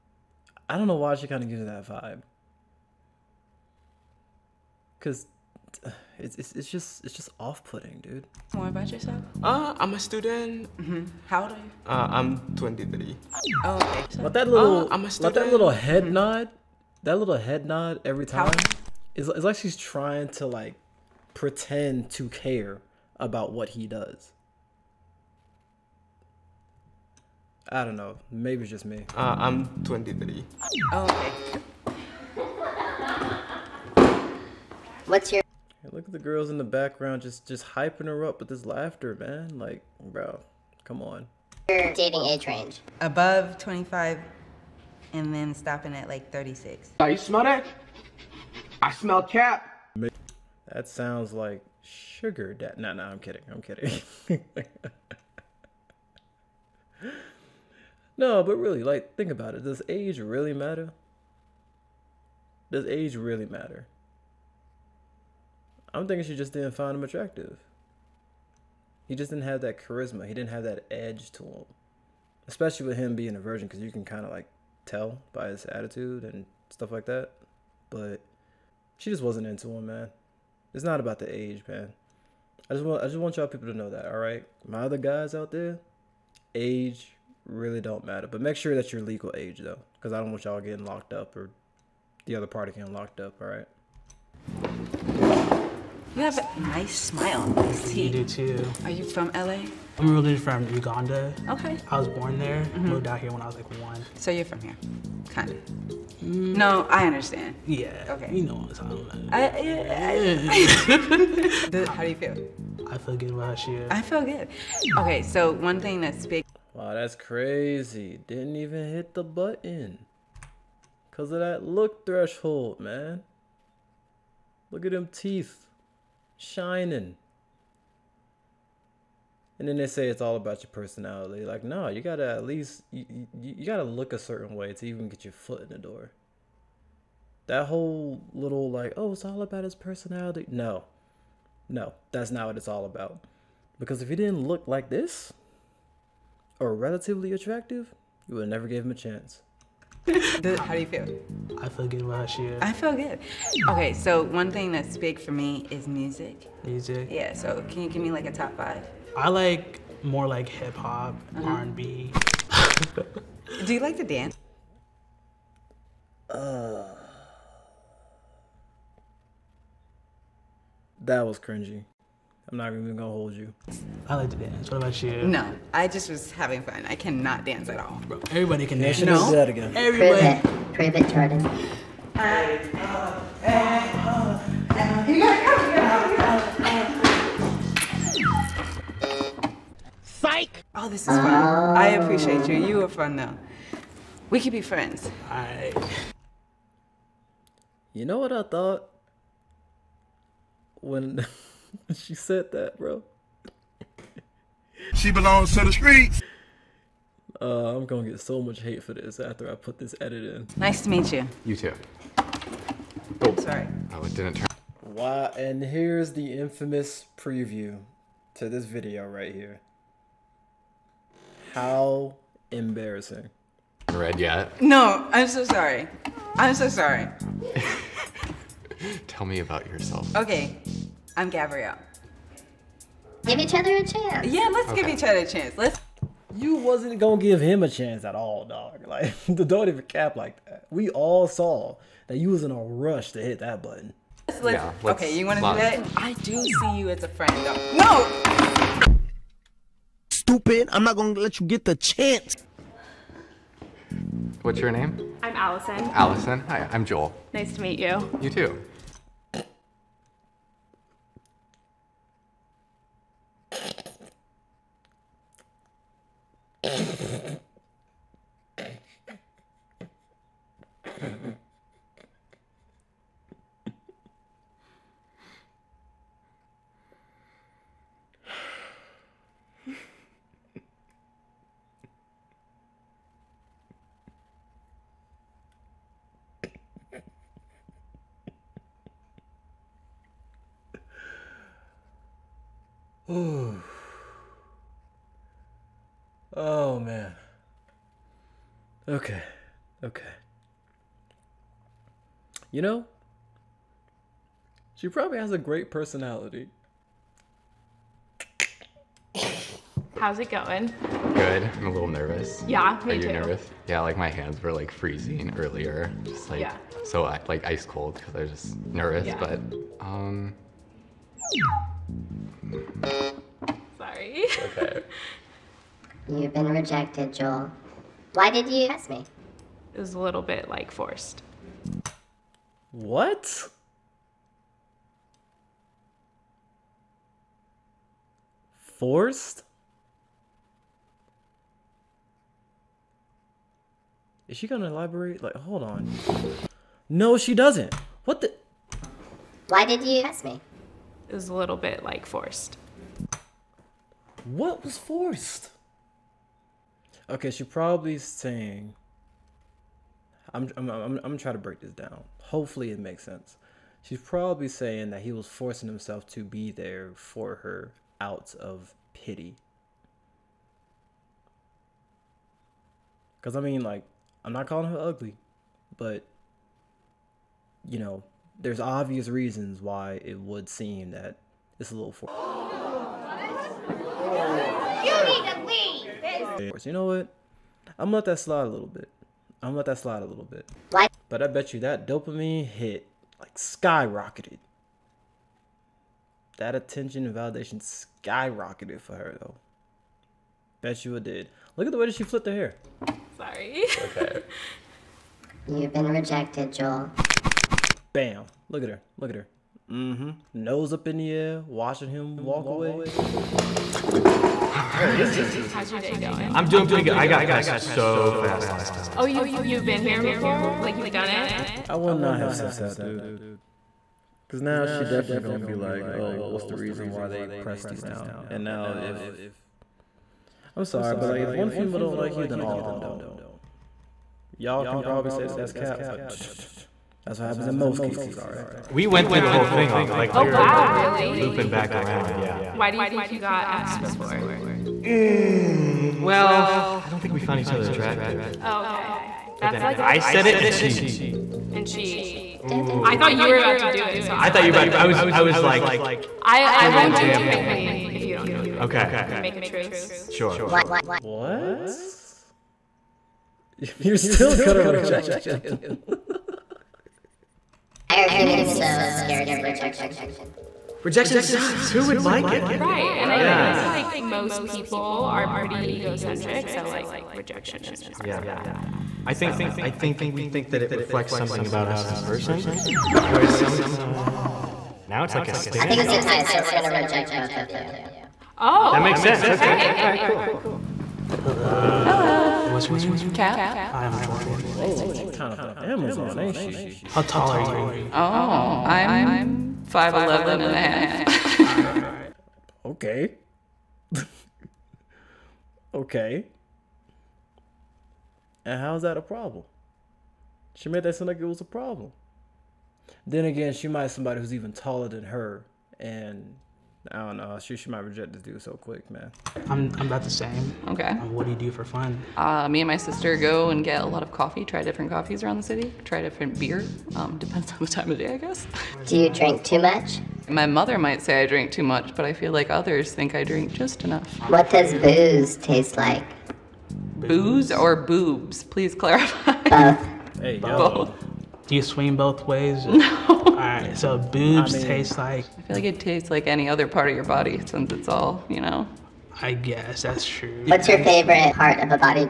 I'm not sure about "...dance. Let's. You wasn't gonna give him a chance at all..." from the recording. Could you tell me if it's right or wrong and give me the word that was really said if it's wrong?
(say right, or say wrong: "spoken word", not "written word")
wrong: "chance", not "dance".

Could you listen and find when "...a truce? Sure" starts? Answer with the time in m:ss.
7:39.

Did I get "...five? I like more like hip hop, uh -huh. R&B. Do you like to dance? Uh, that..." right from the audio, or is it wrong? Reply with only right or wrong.
right.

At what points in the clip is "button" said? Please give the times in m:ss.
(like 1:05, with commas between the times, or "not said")
1:59, 4:03.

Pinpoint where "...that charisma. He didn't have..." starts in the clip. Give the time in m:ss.
1:09.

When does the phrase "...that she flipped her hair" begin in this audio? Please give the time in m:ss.
6:41.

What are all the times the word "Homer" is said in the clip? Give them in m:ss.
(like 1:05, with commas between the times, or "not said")
not said.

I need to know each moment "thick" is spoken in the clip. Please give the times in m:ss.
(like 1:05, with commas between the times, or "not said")
not said.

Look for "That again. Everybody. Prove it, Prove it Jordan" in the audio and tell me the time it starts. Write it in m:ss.
2:59.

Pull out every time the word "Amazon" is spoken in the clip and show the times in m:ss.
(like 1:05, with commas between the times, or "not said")
8:15.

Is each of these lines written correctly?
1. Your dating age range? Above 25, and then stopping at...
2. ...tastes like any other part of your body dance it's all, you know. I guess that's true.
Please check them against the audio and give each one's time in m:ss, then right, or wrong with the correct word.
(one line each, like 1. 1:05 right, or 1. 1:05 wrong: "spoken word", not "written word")
1. 0:41 right
2. 9:05 wrong: "since", not "dance".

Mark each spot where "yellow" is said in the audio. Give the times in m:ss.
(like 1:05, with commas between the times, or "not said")
not said.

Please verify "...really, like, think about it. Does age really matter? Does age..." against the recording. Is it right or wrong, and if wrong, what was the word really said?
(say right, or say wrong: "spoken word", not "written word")
right.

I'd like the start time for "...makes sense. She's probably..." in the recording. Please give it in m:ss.
6:02.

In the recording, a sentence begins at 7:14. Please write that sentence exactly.
Y'all can probably say that that's cap, but.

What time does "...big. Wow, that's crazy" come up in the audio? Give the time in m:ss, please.
1:56.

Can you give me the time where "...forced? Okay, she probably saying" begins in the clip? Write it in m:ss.
5:54.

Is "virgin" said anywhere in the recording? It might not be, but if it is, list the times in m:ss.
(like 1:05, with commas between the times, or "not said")
1:13.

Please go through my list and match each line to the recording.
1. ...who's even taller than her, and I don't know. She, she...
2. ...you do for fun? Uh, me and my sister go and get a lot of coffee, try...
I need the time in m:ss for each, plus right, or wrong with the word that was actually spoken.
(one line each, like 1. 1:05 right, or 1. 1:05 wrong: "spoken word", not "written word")
1. 8:34 right
2. 8:41 right.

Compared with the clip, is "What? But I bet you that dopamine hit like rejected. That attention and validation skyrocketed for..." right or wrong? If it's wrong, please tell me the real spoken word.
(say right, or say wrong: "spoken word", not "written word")
wrong: "skyrocketed", not "rejected".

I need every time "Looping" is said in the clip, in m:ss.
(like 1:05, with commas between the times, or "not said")
7:21.